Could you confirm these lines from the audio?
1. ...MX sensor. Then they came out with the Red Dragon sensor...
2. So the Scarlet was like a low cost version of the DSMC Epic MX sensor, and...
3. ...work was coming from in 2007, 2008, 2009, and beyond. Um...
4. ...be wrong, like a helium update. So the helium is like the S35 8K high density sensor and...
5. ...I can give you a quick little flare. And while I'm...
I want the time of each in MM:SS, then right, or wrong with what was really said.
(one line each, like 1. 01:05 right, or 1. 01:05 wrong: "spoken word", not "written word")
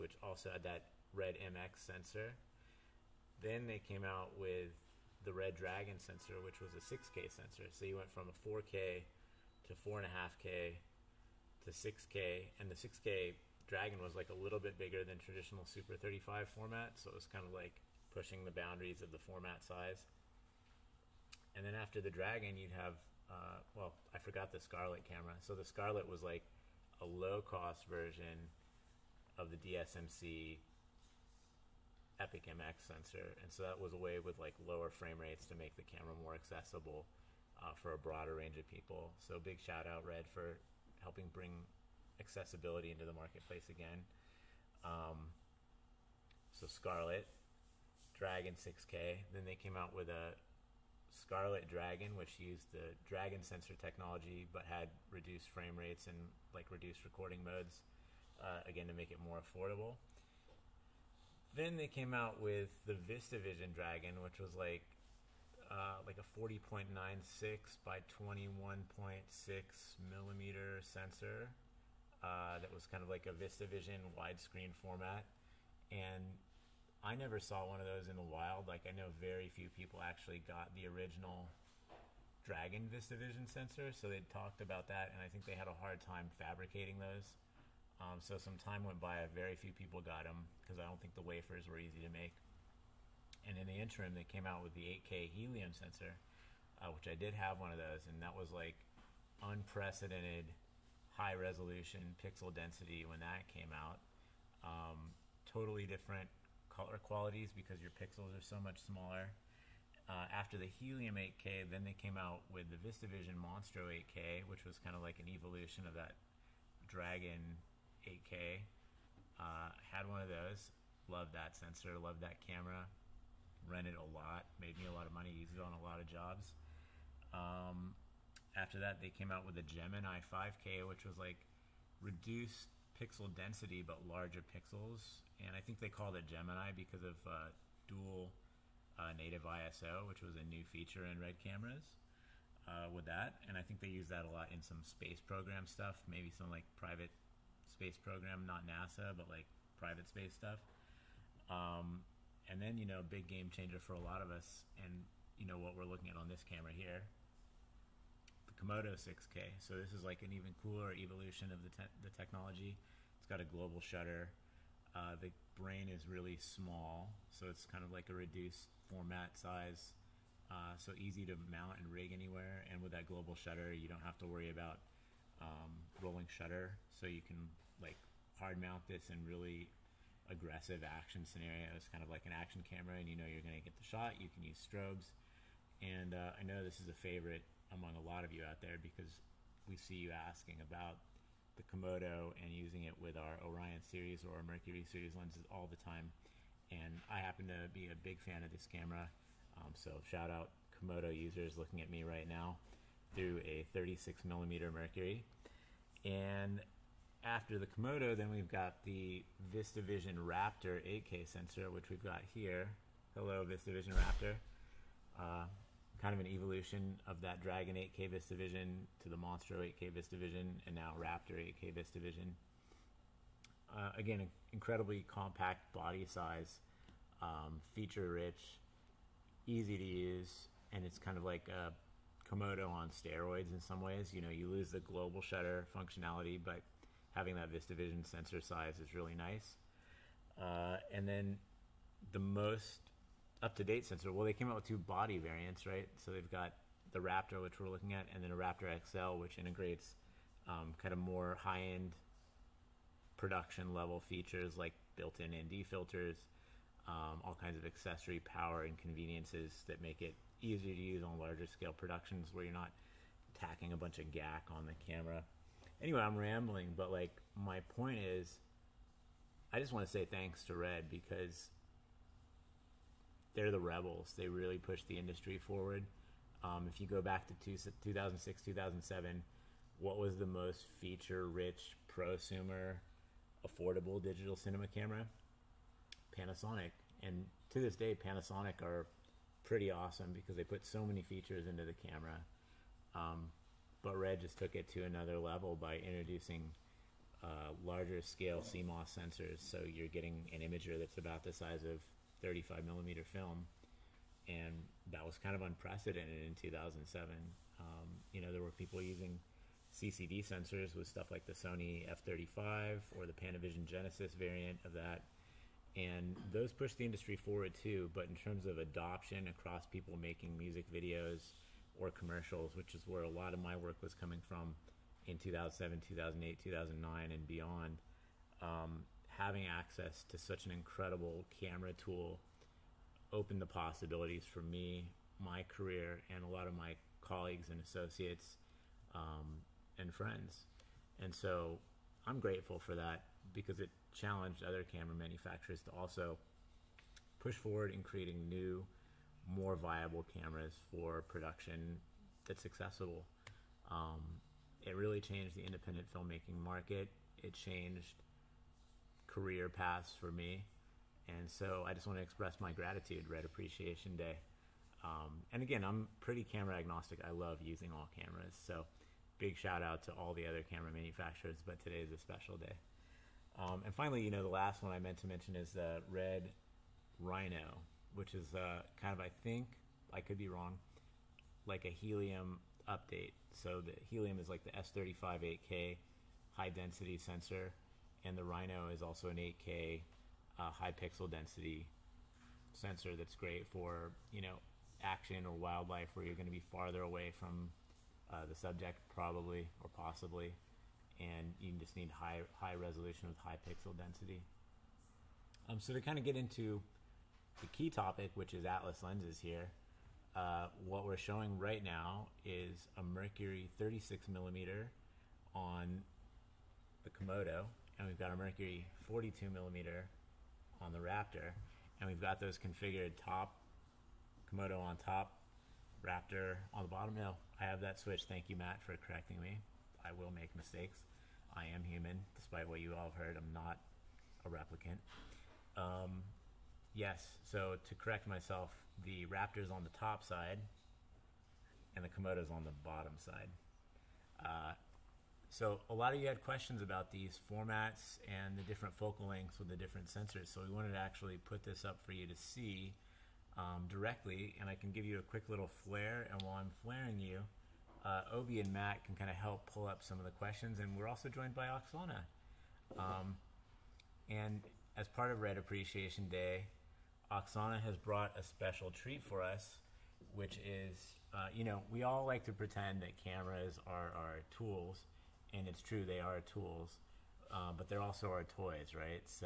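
1. 00:01 right
2. 00:25 right
3. 05:23 right
4. 06:20 right
5. 07:34 right.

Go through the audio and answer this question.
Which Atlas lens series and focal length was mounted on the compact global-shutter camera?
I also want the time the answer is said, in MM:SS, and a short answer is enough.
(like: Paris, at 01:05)
Mercury 36mm, at 03:23.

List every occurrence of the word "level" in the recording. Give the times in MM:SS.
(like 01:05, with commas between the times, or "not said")
04:13, 04:55.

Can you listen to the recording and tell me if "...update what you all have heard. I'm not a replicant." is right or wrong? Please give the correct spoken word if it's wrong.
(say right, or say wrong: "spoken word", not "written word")
wrong: "despite", not "update".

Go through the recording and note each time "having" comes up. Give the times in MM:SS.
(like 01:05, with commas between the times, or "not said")
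03:57, 05:29.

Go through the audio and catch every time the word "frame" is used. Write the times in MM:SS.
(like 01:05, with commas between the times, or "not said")
00:34, 00:55.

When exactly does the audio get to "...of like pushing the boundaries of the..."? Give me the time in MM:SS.
00:17.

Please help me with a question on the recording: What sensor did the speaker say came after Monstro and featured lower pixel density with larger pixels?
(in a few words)
Gemini 5K.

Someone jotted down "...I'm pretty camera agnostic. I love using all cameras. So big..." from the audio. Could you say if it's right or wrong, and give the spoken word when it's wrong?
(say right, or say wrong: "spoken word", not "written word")
right.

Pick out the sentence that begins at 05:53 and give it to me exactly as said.
Um, it really changed the independent filmmaking market.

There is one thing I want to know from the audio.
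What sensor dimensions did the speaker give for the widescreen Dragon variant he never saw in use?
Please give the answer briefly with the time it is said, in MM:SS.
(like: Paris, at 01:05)
40.96 by 21.6 millimeters, at 01:06.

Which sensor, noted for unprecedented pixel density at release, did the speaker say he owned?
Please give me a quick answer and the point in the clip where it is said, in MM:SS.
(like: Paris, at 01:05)
8K Helium, at 01:35.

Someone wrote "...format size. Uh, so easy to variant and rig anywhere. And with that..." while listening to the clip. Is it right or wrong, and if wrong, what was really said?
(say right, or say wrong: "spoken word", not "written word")
wrong: "mount", not "variant".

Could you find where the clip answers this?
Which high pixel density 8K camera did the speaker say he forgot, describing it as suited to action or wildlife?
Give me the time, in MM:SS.
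06:15.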